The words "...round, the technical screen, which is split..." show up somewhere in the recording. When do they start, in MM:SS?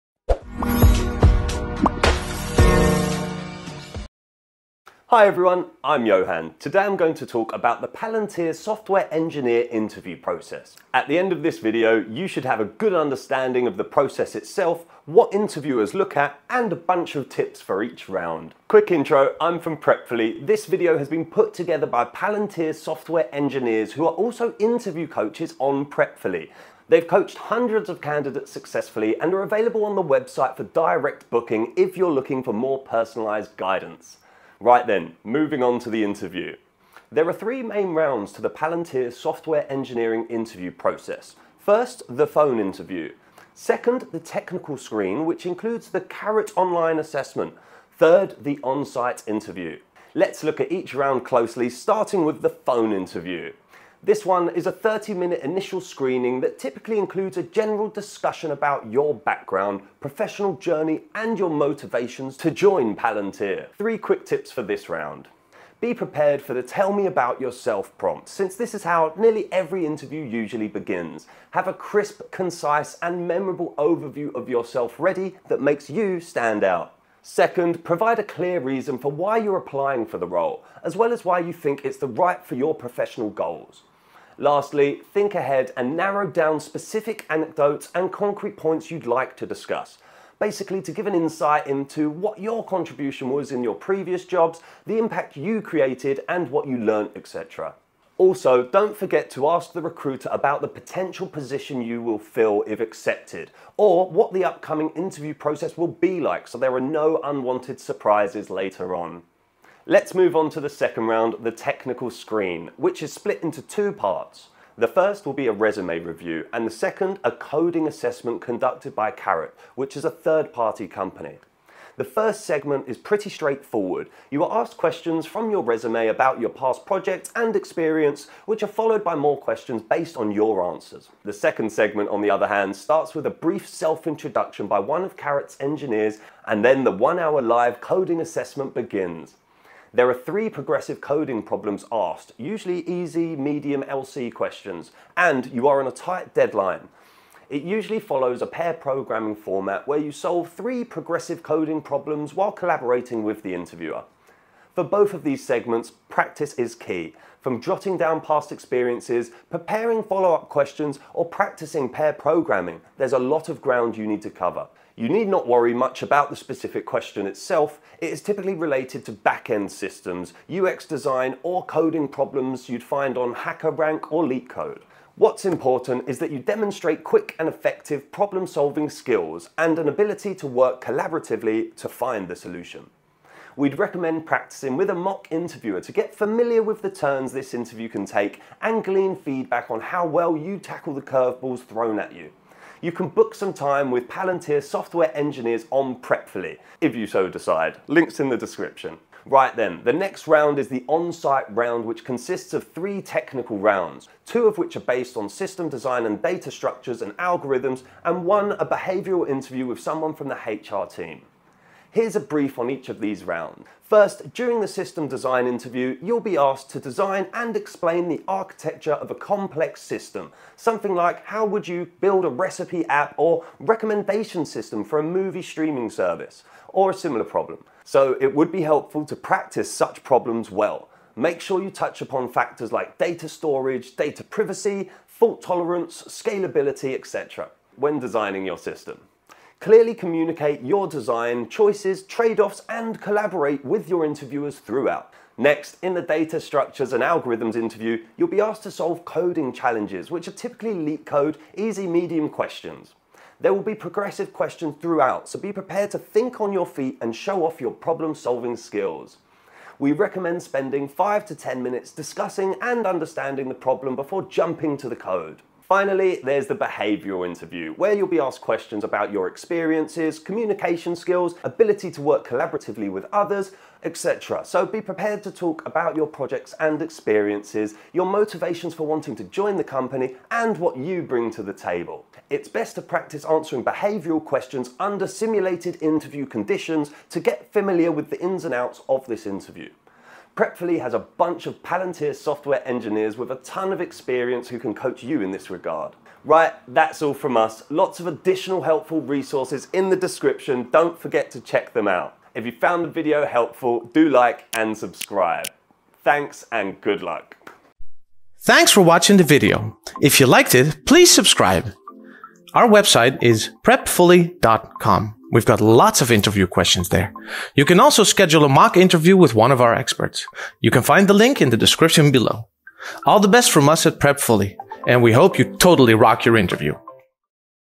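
01:51.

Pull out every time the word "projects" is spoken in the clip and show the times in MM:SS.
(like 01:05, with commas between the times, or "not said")
02:06, 04:36.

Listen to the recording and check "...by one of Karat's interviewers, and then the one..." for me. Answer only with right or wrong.
wrong.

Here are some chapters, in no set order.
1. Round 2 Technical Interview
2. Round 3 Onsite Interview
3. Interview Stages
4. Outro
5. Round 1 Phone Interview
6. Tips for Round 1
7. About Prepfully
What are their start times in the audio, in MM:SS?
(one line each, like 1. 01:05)
1. 01:51
2. 03:22
3. 00:37
4. 04:52
5. 00:53
6. 01:04
7. 00:19.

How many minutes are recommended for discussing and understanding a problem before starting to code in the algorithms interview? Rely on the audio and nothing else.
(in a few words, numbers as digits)
5 to 10 minutes.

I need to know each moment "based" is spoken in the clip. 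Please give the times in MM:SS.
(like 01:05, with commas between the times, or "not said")
02:09, 03:24.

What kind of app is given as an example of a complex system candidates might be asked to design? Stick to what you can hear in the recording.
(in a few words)
Recipe app.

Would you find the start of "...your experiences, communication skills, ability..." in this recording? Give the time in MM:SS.
04:29.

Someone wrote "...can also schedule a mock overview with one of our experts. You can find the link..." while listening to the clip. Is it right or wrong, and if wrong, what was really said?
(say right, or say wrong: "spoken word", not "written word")
wrong: "interview", not "overview".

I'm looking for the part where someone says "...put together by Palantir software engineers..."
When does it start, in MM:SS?
00:21.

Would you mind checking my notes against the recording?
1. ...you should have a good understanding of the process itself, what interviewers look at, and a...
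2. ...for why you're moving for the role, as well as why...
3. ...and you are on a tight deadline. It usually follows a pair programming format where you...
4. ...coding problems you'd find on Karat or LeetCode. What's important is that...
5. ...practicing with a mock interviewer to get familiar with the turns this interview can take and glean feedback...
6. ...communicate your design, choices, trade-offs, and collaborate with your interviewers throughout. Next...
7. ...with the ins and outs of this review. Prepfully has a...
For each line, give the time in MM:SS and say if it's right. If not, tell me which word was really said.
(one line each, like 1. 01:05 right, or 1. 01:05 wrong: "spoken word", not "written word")
1. 00:12 right
2. 01:18 wrong: "applying", not "moving"
3. 02:25 right
4. 02:51 wrong: "HackerRank", not "Karat"
5. 03:04 right
6. 03:59 right
7. 04:47 wrong: "interview", not "review".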